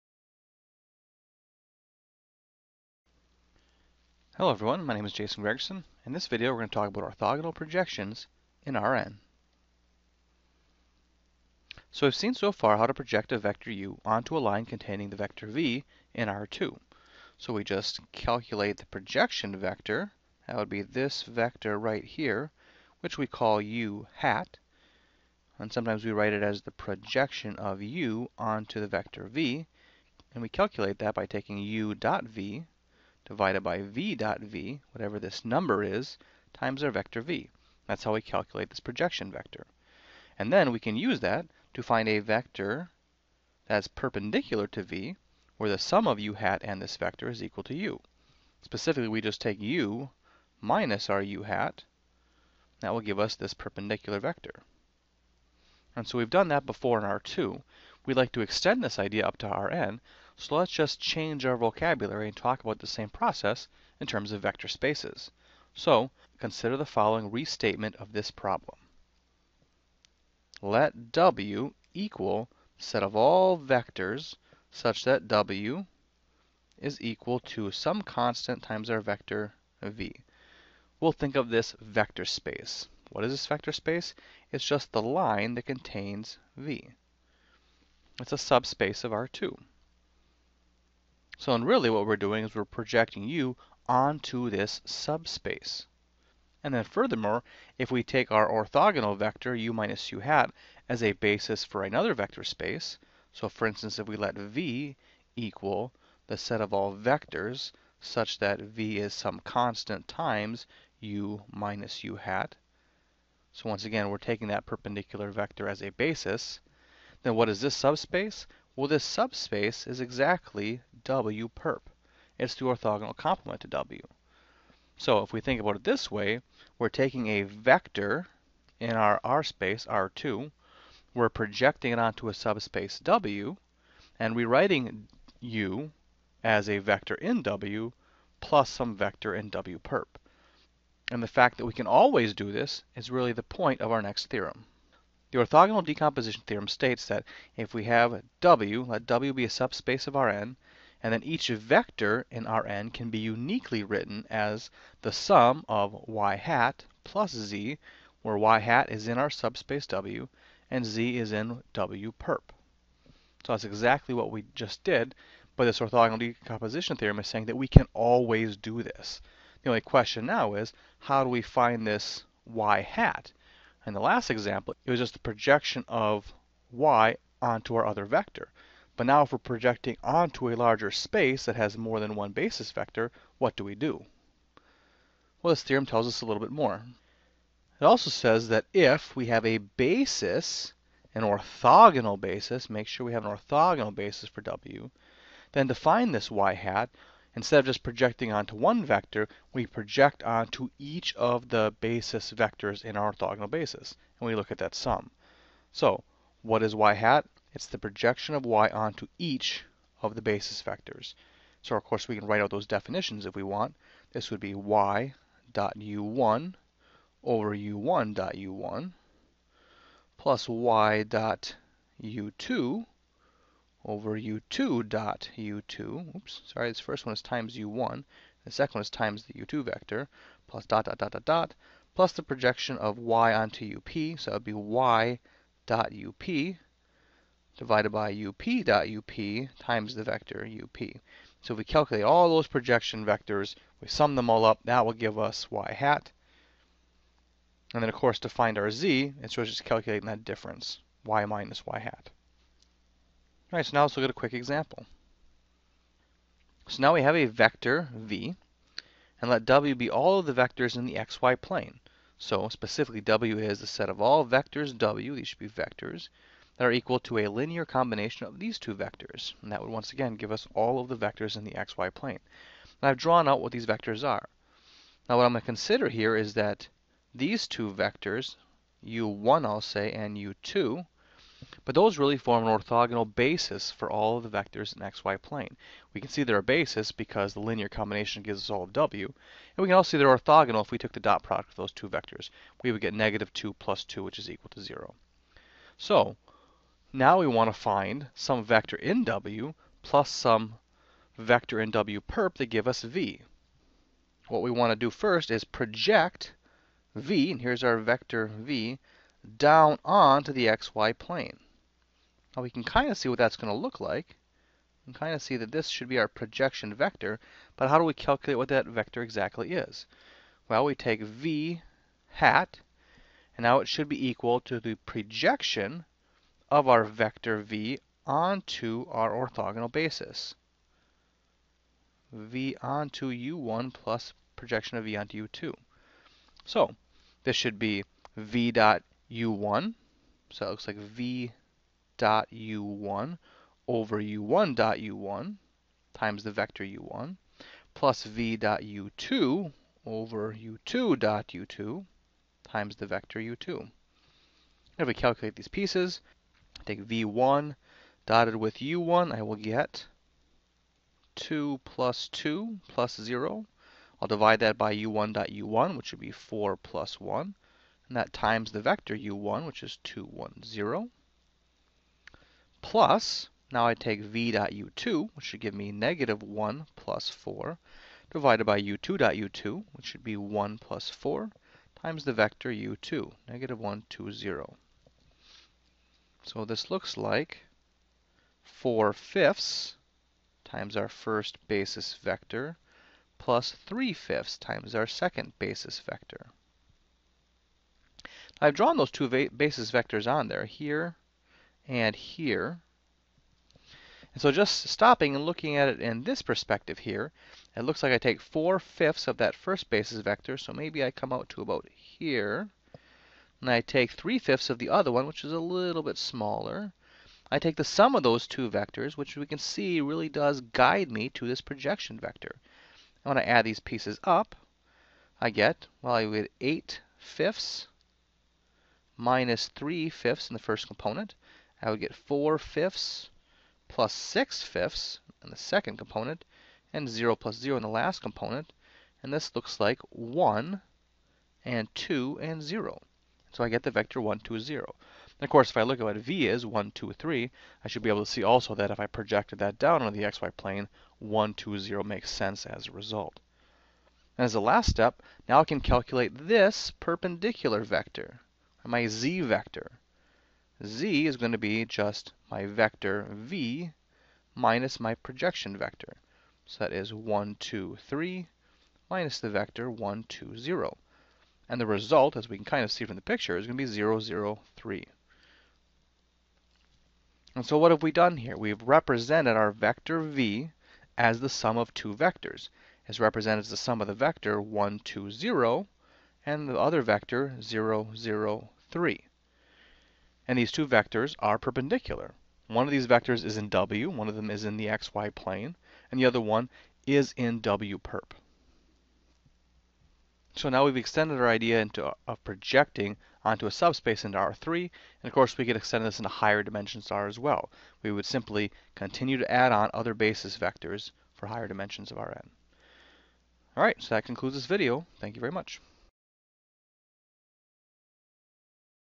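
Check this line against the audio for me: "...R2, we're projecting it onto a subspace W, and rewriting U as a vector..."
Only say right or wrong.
right.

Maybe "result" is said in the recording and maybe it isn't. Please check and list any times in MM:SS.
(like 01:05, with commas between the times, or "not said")
07:32, 07:51.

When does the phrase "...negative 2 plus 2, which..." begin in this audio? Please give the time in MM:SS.
04:52.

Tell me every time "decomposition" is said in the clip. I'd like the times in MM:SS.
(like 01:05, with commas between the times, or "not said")
02:25, 02:46.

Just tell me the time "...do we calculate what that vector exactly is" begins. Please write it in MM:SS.
05:17.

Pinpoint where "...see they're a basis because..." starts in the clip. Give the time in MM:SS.
04:46.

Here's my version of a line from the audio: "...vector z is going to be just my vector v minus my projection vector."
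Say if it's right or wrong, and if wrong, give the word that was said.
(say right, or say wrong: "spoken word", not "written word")
right.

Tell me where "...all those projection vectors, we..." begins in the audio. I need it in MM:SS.
04:02.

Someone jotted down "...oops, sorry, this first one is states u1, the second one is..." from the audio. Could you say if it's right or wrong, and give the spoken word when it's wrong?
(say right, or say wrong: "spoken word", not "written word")
wrong: "times", not "states".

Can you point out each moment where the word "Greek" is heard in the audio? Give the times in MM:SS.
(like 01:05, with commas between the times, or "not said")
not said.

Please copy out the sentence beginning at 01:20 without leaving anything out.
We'll think of this vector space.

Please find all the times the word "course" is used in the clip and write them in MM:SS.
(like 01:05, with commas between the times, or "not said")
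03:31, 04:07, 07:25, 08:25.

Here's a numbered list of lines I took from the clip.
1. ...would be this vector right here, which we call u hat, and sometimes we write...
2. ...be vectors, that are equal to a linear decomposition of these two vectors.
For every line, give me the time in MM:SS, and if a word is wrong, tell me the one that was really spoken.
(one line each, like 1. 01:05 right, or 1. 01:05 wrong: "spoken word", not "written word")
1. 00:20 right
2. 04:25 wrong: "combination", not "decomposition".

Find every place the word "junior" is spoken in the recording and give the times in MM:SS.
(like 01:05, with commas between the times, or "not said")
not said.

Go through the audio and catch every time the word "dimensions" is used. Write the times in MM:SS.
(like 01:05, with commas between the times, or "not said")
08:26, 08:31.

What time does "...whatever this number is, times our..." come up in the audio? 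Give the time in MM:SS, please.
00:34.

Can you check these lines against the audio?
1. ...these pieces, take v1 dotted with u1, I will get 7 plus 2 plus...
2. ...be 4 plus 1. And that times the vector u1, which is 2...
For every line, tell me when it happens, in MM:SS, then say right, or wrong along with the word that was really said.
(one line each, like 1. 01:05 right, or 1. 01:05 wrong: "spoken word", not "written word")
1. 05:55 wrong: "2", not "7"
2. 06:06 right.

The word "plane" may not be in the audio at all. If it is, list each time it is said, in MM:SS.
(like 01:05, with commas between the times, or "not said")
04:21, 04:31, 04:45, 05:10, 07:30, 08:15.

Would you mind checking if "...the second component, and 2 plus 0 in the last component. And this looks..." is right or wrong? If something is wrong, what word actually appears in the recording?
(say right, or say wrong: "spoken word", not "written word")
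wrong: "0", not "2".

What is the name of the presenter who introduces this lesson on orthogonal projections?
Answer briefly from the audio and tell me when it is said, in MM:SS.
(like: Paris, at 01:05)
Jason Gregersen, at 00:05.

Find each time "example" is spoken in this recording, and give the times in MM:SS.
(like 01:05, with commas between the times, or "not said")
02:54, 04:14.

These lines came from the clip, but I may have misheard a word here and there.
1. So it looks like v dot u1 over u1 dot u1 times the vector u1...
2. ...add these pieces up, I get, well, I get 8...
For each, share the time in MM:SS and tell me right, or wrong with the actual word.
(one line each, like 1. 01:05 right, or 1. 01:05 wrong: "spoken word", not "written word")
1. 05:40 right
2. 07:03 right.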